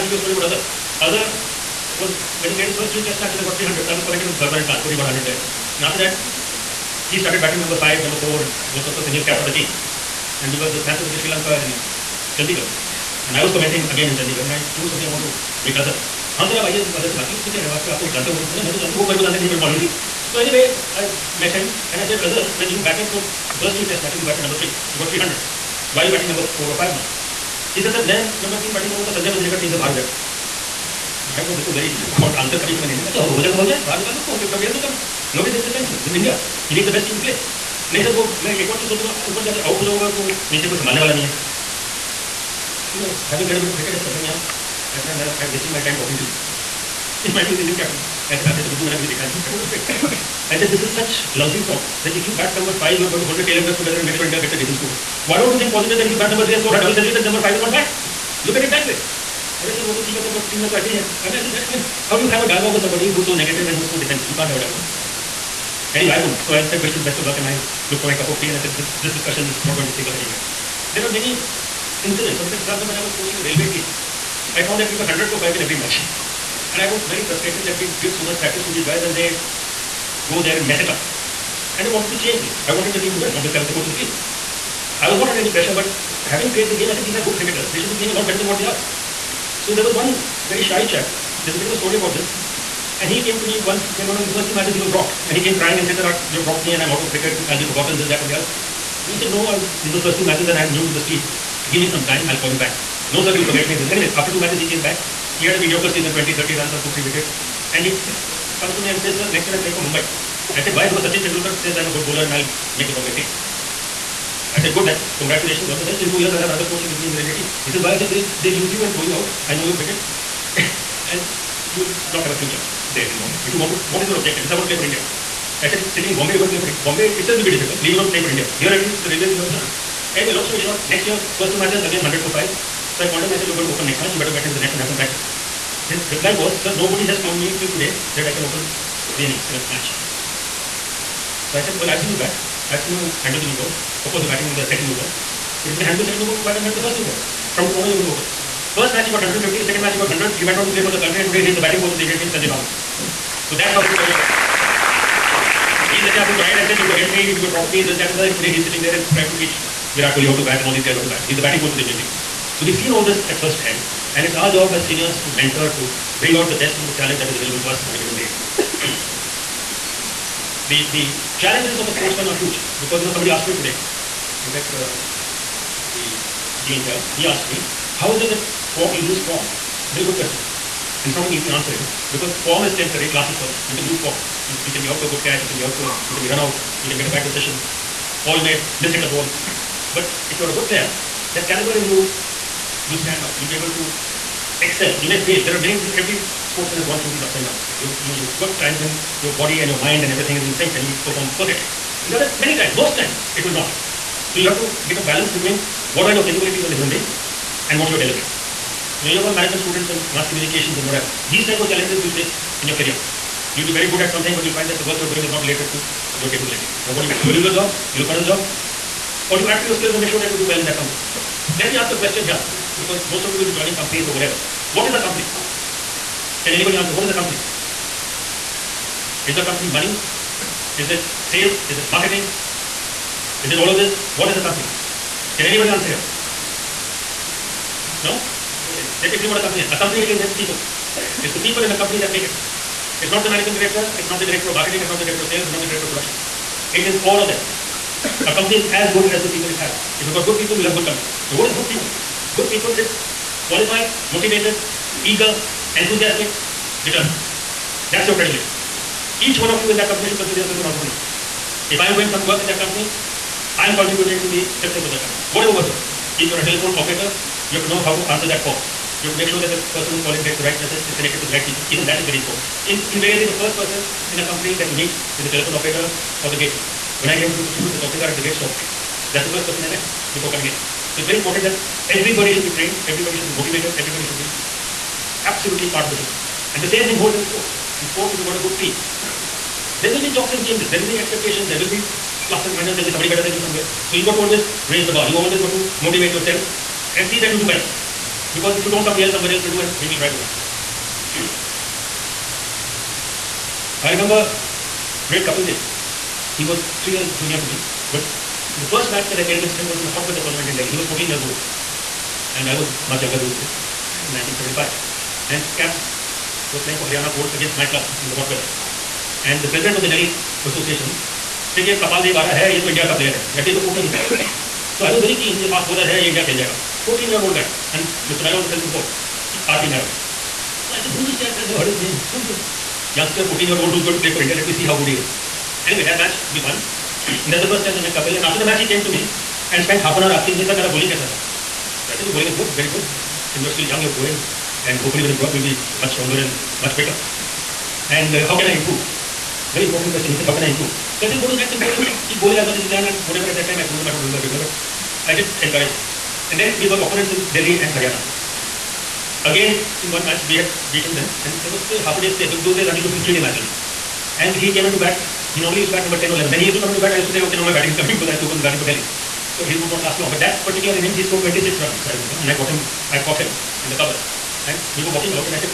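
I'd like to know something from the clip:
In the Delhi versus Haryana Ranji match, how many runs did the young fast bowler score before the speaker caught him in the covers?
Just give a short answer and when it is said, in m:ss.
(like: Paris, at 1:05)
26, at 6:11.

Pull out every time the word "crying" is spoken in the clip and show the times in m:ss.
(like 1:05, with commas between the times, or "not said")
1:35.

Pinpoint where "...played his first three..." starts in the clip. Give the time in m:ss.
0:02.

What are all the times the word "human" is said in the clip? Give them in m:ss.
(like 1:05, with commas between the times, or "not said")
3:26.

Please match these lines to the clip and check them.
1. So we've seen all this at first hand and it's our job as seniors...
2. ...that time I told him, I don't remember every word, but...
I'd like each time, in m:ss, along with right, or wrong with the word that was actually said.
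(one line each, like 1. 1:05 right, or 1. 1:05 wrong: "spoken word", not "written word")
1. 2:42 right
2. 5:53 right.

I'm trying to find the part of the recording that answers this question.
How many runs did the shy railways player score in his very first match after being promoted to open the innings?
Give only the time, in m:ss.
2:29.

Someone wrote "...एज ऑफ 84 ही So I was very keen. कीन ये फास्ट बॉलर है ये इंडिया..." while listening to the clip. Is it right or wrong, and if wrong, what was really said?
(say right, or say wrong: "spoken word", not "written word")
wrong: "14", not "84".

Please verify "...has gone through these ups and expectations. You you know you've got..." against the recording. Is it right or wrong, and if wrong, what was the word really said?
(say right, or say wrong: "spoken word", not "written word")
wrong: "downs", not "expectations".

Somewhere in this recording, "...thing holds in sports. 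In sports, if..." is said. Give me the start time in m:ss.
4:46.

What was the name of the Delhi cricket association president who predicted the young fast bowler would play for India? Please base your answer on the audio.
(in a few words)
R.P. Mehra.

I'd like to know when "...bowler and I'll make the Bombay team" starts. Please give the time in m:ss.
1:52.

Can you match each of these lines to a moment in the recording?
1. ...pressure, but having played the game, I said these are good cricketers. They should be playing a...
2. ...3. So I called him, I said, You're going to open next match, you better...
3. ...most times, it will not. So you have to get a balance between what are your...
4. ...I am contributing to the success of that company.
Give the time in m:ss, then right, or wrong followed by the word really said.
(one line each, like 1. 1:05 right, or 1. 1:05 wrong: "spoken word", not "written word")
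1. 1:25 right
2. 2:12 wrong: "5", not "3"
3. 3:22 right
4. 4:23 right.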